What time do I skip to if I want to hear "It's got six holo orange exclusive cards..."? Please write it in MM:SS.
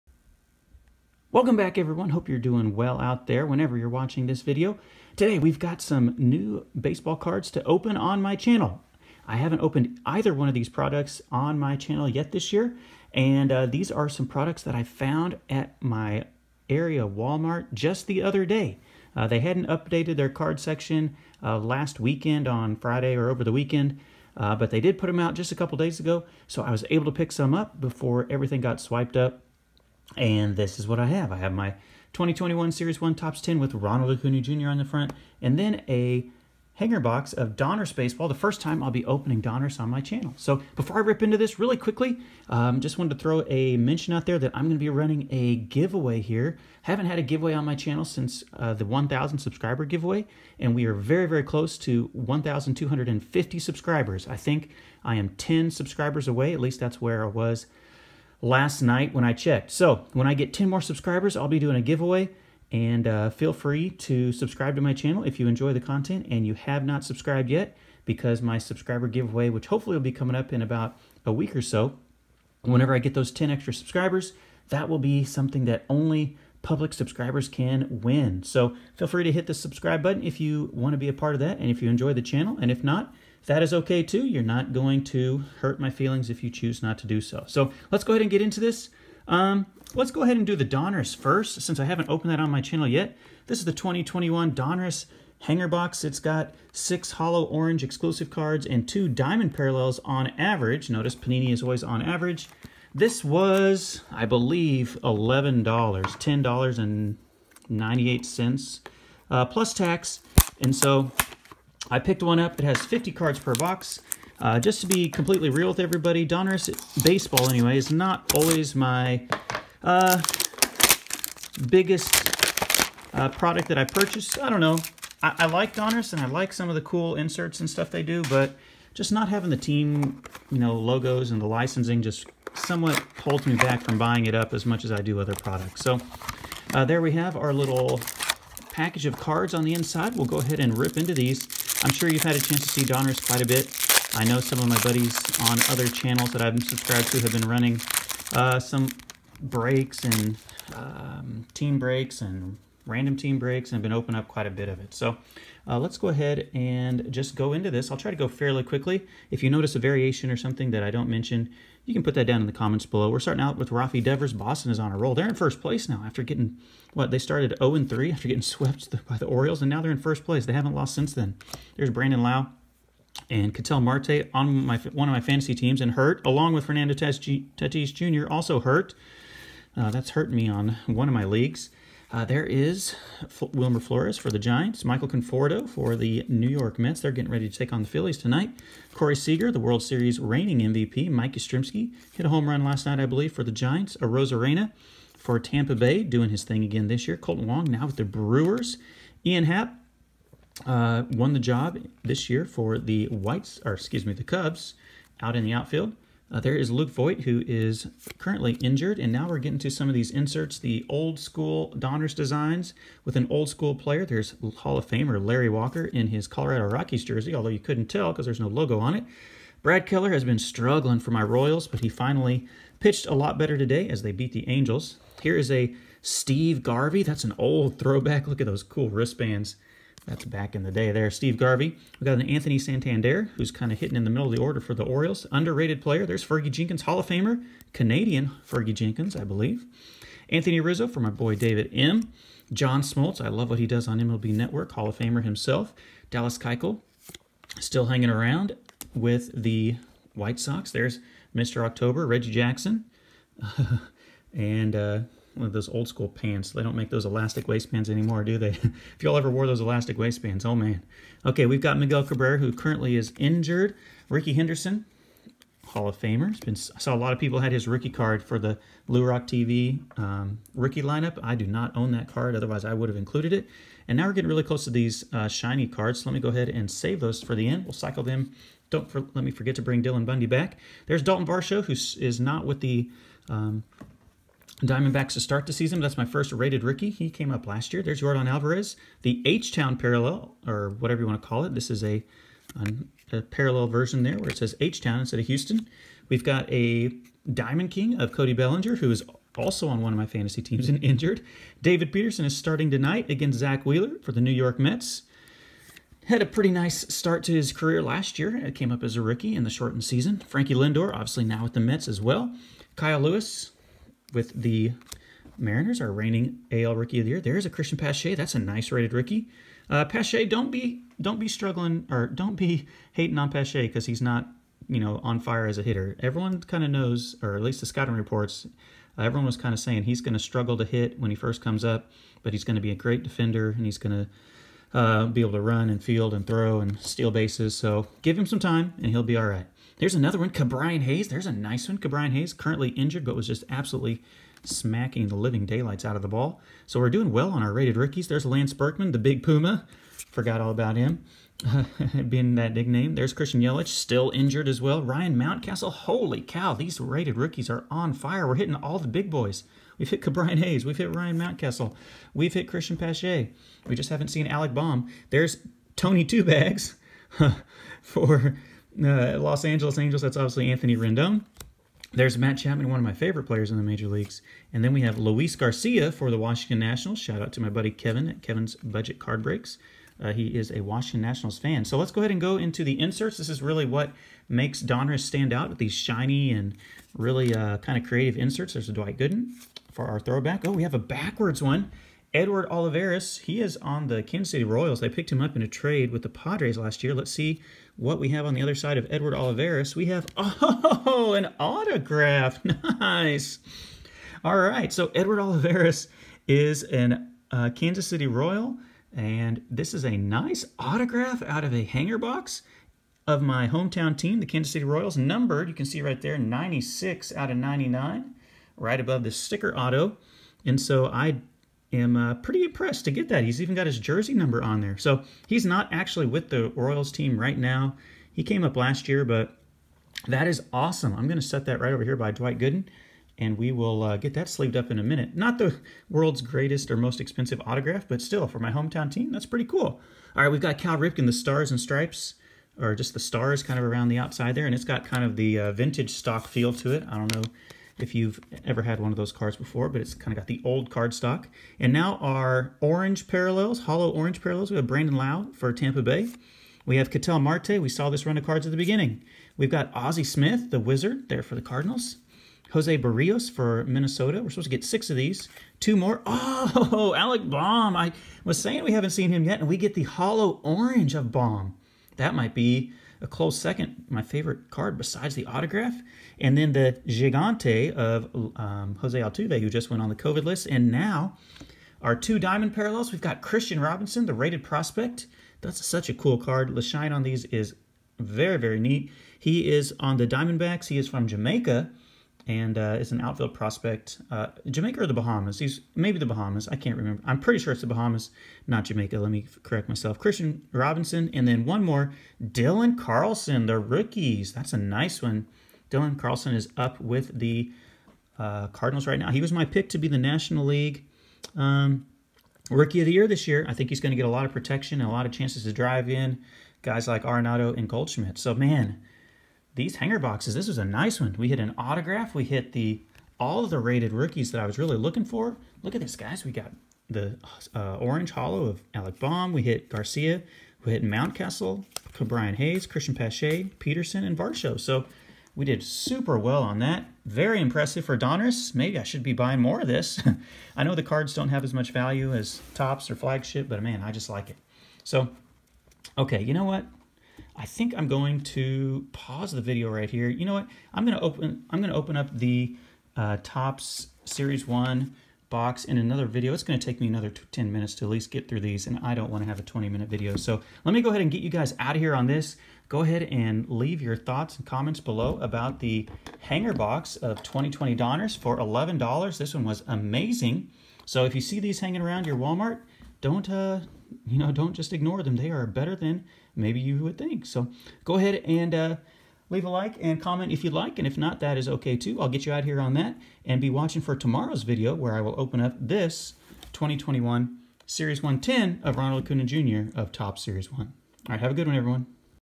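01:36.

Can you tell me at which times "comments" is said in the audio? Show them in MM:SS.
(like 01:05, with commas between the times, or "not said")
02:42, 09:24, 09:40.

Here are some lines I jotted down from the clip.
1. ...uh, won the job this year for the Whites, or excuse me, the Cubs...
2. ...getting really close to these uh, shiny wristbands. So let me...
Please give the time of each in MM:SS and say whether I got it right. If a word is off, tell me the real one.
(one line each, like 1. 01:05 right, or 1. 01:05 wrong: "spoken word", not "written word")
1. 03:20 right
2. 04:34 wrong: "cards", not "wristbands".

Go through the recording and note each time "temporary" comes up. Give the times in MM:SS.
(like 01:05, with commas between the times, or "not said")
not said.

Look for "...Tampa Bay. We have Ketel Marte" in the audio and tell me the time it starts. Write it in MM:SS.
07:35.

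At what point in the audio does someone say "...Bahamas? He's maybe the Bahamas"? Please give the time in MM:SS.
08:14.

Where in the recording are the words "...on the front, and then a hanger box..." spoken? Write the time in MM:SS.
00:34.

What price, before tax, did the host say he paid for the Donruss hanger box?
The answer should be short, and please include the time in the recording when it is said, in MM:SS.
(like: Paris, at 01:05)
$10.98, at 01:45.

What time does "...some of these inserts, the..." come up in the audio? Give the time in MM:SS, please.
03:29.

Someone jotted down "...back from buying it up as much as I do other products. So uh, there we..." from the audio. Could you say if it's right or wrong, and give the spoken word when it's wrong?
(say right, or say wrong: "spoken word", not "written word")
right.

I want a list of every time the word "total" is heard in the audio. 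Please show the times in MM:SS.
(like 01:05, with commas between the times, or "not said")
not said.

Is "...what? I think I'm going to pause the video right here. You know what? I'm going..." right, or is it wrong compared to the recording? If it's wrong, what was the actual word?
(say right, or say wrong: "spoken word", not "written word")
right.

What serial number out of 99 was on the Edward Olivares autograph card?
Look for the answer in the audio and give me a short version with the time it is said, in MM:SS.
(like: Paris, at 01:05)
96, at 06:56.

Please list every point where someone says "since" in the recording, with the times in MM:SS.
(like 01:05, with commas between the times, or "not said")
00:48, 01:31, 02:50.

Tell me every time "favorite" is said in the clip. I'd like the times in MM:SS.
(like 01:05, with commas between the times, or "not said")
06:12, 07:54.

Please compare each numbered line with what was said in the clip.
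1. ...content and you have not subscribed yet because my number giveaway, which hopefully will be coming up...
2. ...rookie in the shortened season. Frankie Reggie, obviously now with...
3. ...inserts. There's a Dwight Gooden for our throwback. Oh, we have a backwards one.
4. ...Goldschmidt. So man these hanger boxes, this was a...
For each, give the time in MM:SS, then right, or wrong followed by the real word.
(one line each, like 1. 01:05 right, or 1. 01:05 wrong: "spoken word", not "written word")
1. 01:05 wrong: "subscriber", not "number"
2. 05:09 wrong: "Lindor", not "Reggie"
3. 06:28 right
4. 08:37 right.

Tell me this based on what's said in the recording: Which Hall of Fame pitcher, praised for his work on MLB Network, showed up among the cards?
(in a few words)
John Smoltz.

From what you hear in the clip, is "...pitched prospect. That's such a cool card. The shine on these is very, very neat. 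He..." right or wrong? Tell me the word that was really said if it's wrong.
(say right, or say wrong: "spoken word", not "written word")
wrong: "rated", not "pitched".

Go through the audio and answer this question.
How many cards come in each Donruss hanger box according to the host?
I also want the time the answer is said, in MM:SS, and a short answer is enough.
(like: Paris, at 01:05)
50, at 01:52.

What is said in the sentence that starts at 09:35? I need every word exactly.
They are better than maybe you would think.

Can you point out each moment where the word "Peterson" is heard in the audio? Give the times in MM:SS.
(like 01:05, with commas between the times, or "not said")
05:01, 08:53.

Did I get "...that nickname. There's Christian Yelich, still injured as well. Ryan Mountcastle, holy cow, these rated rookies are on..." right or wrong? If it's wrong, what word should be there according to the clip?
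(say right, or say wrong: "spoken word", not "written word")
right.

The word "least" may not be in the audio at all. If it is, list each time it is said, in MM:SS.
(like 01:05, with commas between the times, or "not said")
00:56, 05:27, 09:17.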